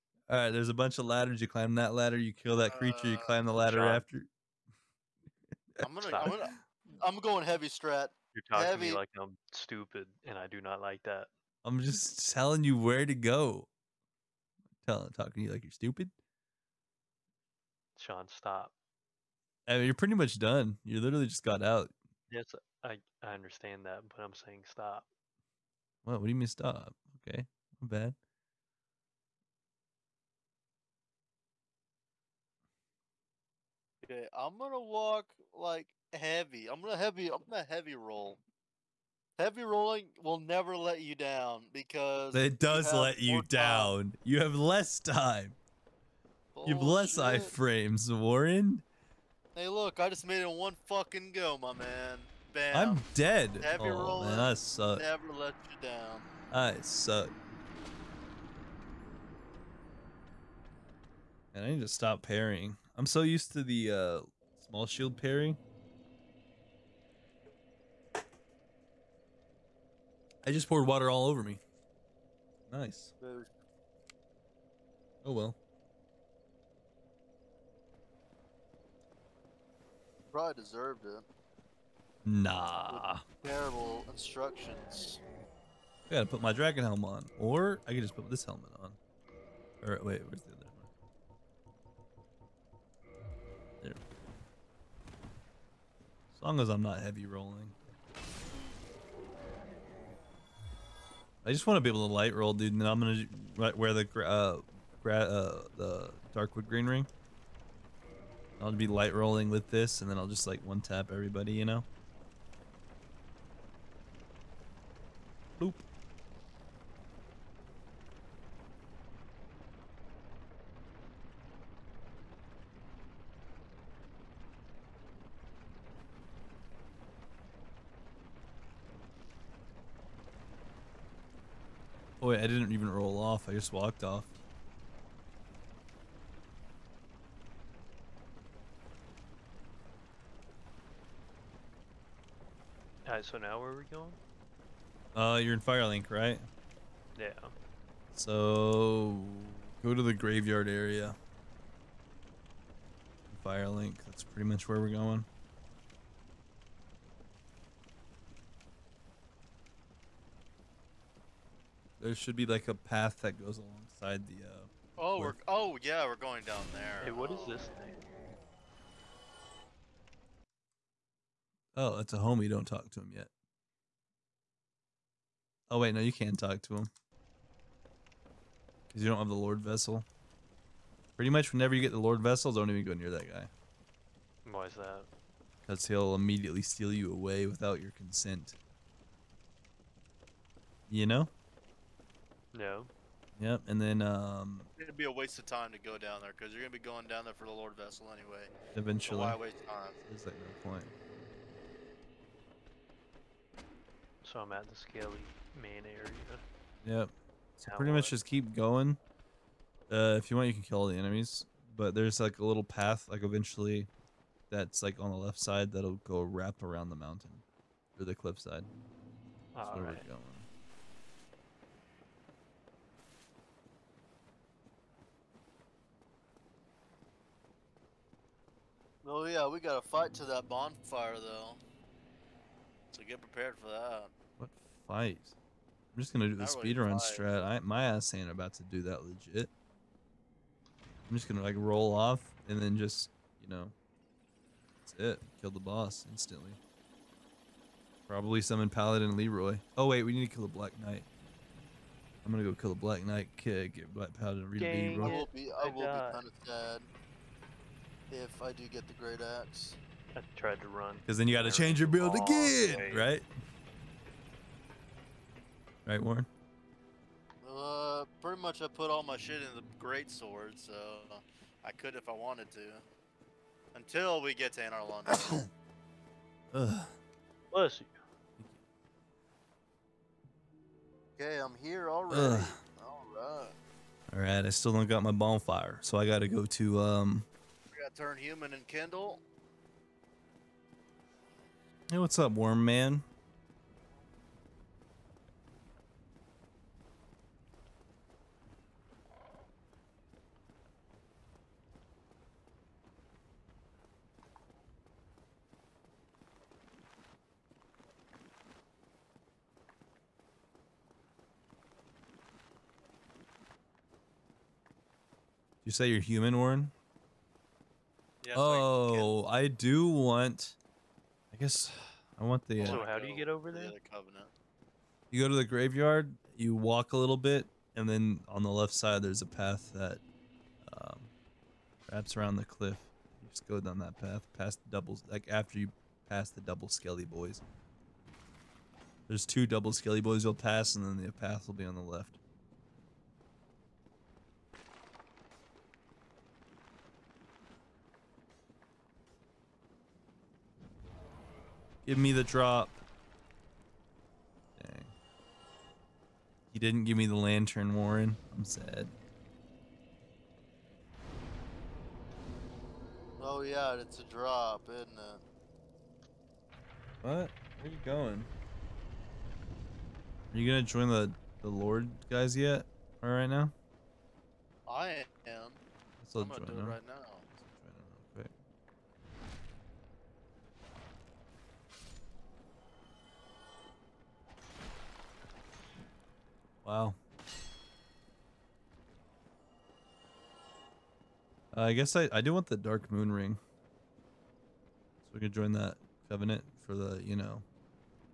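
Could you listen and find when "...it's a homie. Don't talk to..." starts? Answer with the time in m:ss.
2:51.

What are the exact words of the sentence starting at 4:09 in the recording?
Oh wait, we need to kill the Black Knight.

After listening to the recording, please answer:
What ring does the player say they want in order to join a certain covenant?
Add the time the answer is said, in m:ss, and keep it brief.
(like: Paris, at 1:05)
Dark Moon Ring, at 6:32.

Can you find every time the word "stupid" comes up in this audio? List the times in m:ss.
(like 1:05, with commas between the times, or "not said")
0:09, 0:15.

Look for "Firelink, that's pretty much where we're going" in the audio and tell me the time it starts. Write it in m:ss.
2:33.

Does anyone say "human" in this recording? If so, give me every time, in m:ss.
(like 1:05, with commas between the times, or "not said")
4:48, 5:16.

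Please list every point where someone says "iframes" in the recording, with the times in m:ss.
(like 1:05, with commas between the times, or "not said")
0:47.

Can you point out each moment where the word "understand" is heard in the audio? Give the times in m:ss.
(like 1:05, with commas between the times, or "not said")
0:23.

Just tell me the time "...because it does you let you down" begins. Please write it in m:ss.
0:41.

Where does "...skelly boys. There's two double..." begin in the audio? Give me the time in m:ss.
5:36.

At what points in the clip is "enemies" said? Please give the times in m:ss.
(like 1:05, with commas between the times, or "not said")
3:30.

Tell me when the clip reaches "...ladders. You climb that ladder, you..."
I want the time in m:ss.
0:01.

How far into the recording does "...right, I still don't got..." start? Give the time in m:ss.
4:44.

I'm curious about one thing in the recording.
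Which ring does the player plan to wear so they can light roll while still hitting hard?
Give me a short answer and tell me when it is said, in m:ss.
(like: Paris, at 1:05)
Darkwood grain ring, at 1:46.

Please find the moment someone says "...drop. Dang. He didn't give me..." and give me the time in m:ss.
5:52.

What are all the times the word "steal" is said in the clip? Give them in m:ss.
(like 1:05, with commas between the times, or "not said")
3:06.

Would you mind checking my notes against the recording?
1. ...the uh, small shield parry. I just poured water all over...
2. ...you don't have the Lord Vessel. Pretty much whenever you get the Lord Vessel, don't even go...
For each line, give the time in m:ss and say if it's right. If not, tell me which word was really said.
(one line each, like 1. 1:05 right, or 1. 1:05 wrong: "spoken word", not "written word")
1. 1:03 right
2. 2:59 right.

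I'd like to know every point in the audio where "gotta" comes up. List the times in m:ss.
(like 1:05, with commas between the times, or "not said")
1:26, 3:49.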